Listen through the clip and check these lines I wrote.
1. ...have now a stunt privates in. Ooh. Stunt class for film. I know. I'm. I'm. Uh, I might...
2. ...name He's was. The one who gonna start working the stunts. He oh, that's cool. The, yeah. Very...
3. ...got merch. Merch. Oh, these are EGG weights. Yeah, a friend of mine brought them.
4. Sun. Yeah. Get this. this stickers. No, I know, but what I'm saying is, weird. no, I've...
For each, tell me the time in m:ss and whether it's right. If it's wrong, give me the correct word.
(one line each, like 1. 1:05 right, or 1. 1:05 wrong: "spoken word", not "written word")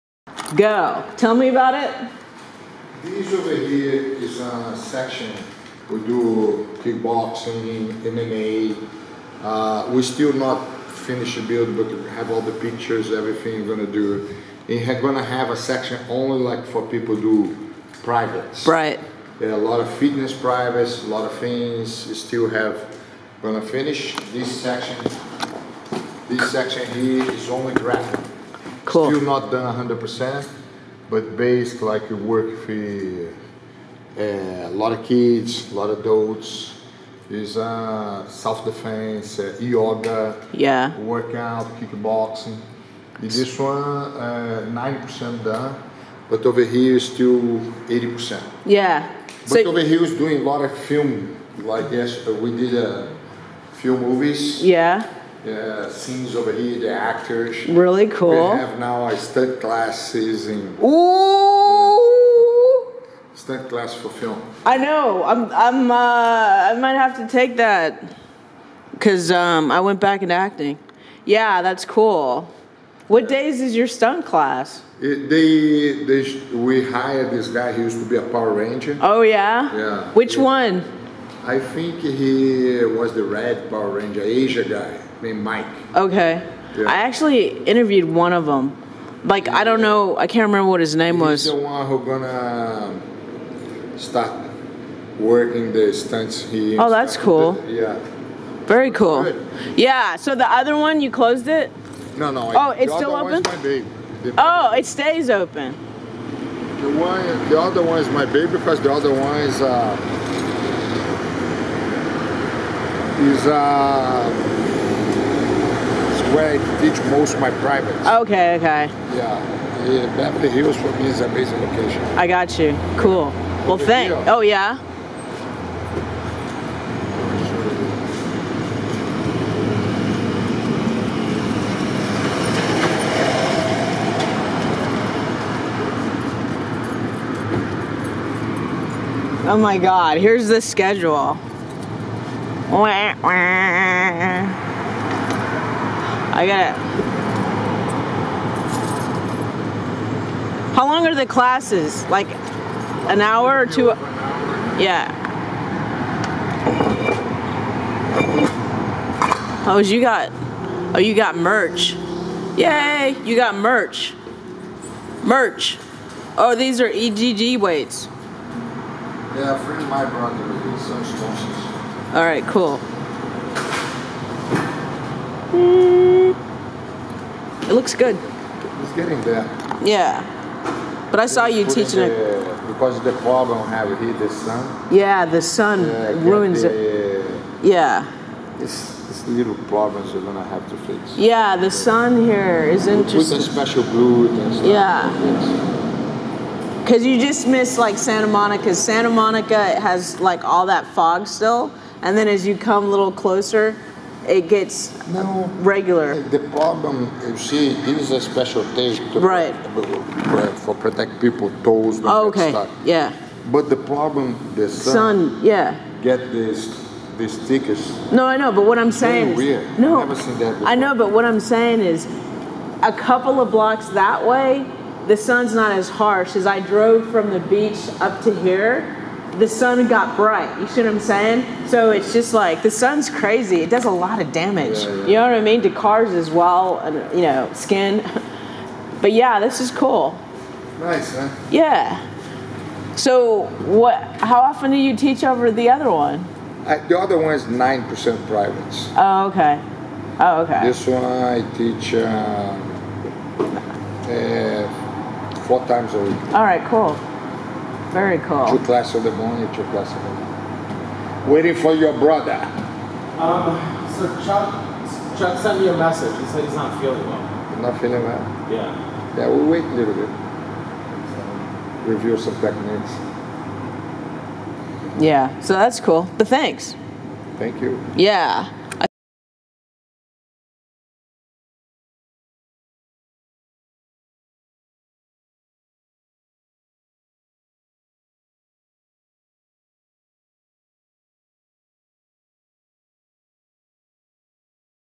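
1. 0:58 wrong: "classes", not "privates"
2. 1:30 right
3. 2:43 right
4. 3:35 right.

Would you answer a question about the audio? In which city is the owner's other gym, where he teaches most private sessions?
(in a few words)
Beverly Hills.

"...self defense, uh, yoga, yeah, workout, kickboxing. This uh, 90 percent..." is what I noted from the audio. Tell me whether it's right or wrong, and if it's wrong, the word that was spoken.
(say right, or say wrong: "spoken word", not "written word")
right.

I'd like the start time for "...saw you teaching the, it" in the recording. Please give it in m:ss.
3:01.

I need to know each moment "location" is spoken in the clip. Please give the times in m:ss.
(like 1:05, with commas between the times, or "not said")
2:01.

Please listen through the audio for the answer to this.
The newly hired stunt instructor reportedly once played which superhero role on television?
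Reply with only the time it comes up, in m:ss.
1:23.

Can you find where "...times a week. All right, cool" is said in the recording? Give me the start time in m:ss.
4:15.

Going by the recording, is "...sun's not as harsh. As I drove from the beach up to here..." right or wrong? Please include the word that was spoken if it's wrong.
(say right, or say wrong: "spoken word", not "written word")
right.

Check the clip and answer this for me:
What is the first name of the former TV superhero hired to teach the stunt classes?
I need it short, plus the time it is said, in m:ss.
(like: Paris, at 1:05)
Mike, at 1:25.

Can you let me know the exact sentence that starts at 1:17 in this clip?
He used to be a Power Ranger.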